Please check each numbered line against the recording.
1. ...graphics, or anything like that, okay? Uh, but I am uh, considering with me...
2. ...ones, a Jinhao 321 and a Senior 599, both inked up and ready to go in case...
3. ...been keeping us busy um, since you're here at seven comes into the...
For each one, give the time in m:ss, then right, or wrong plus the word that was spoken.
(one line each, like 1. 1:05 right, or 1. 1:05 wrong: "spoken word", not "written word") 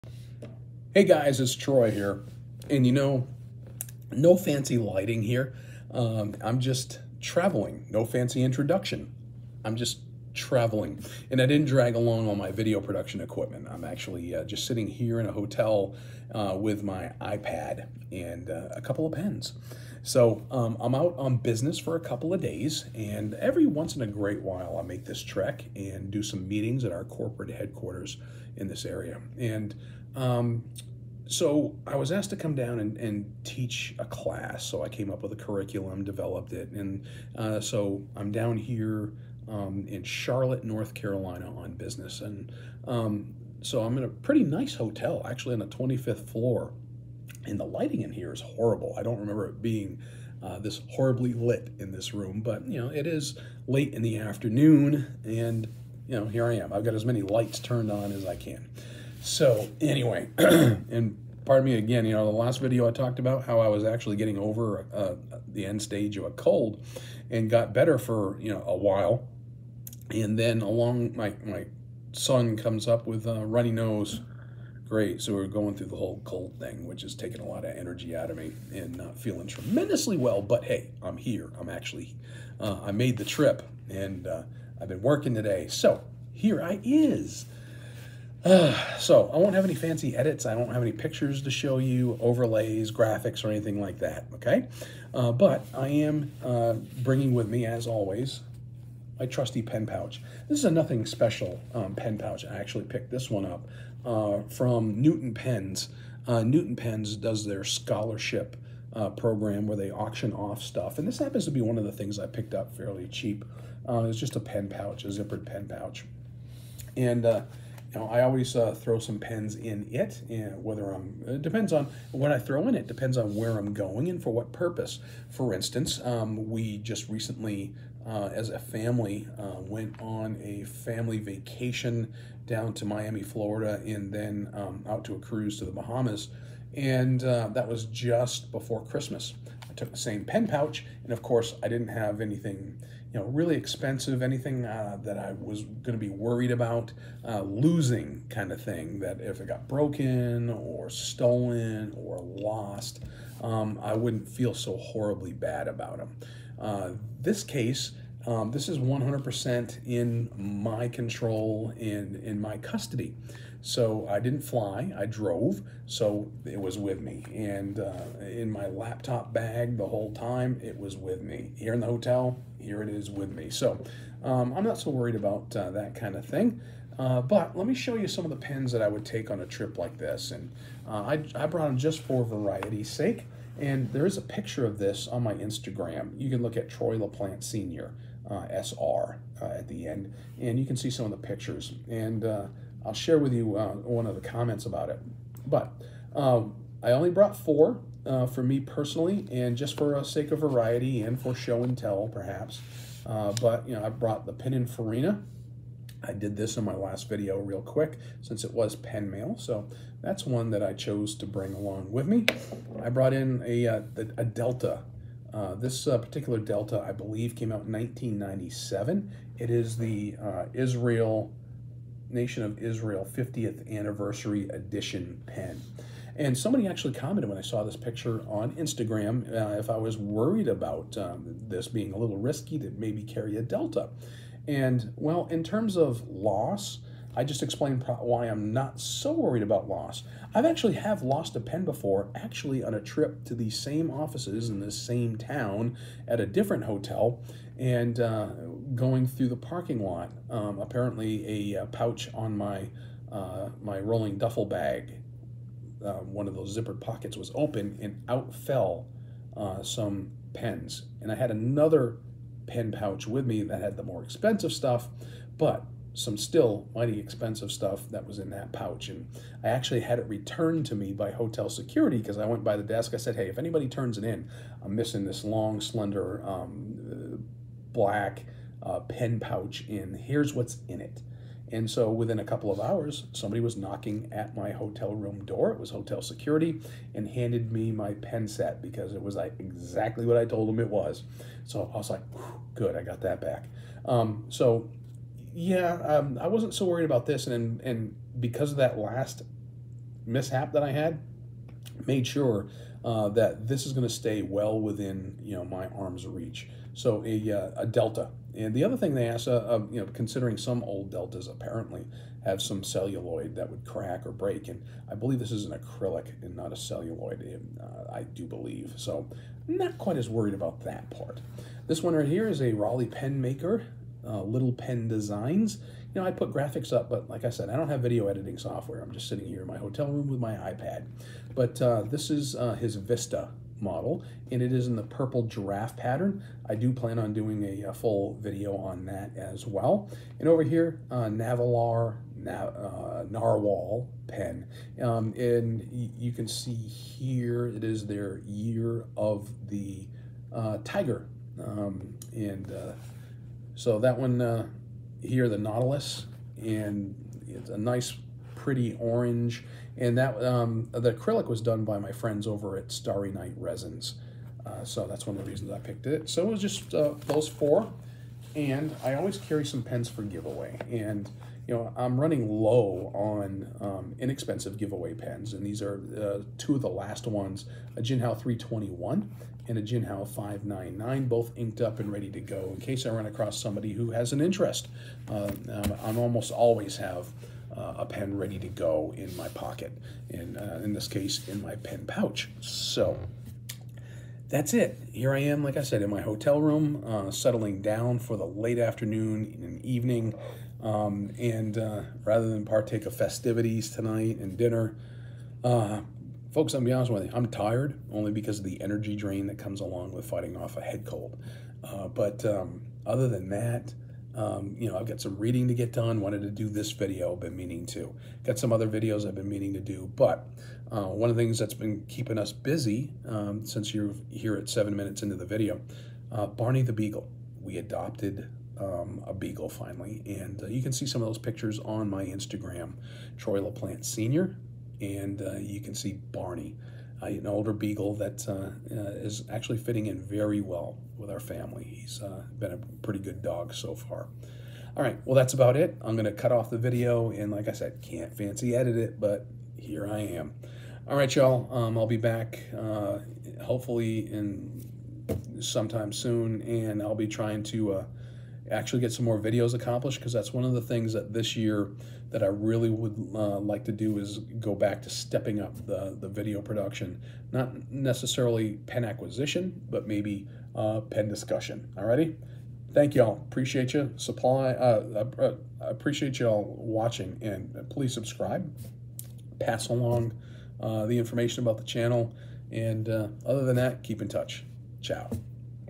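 1. 1:32 wrong: "bringing", not "considering"
2. 6:17 wrong: "Jinhao", not "Senior"
3. 7:01 wrong: "minutes", not "comes".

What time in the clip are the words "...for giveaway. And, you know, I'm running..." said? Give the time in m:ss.
6:09.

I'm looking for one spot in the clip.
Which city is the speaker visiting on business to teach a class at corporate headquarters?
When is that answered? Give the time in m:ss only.
0:40.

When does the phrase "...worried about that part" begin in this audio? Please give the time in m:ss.
5:20.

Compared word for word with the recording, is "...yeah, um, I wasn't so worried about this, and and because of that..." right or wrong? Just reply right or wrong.
right.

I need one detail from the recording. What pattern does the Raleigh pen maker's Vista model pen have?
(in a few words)
purple giraffe.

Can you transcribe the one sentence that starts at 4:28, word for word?
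And I actually had it returned to me by hotel security because I went by the desk.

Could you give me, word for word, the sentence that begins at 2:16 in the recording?
And uh, that was just before Christmas.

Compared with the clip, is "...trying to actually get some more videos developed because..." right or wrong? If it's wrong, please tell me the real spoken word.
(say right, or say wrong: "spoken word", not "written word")
wrong: "accomplished", not "developed".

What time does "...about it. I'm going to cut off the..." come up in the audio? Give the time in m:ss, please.
7:25.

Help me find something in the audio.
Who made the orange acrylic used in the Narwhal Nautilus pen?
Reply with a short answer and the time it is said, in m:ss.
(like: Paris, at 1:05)
Starry Night Resins, at 6:02.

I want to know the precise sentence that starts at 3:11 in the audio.
And uh, I'll share with you uh, one of the comments about it.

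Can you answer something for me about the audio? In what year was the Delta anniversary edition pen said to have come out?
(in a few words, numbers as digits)
1997.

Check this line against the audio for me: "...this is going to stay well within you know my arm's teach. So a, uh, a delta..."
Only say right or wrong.
wrong.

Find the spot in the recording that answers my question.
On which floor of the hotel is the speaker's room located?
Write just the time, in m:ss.
0:45.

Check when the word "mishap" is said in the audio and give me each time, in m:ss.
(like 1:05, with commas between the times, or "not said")
5:00.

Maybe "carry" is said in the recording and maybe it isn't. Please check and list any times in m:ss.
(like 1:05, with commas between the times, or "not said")
3:53, 6:09.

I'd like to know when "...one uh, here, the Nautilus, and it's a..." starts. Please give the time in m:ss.
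5:53.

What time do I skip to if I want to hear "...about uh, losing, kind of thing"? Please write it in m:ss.
2:26.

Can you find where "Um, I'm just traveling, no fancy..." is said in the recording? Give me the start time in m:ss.
0:05.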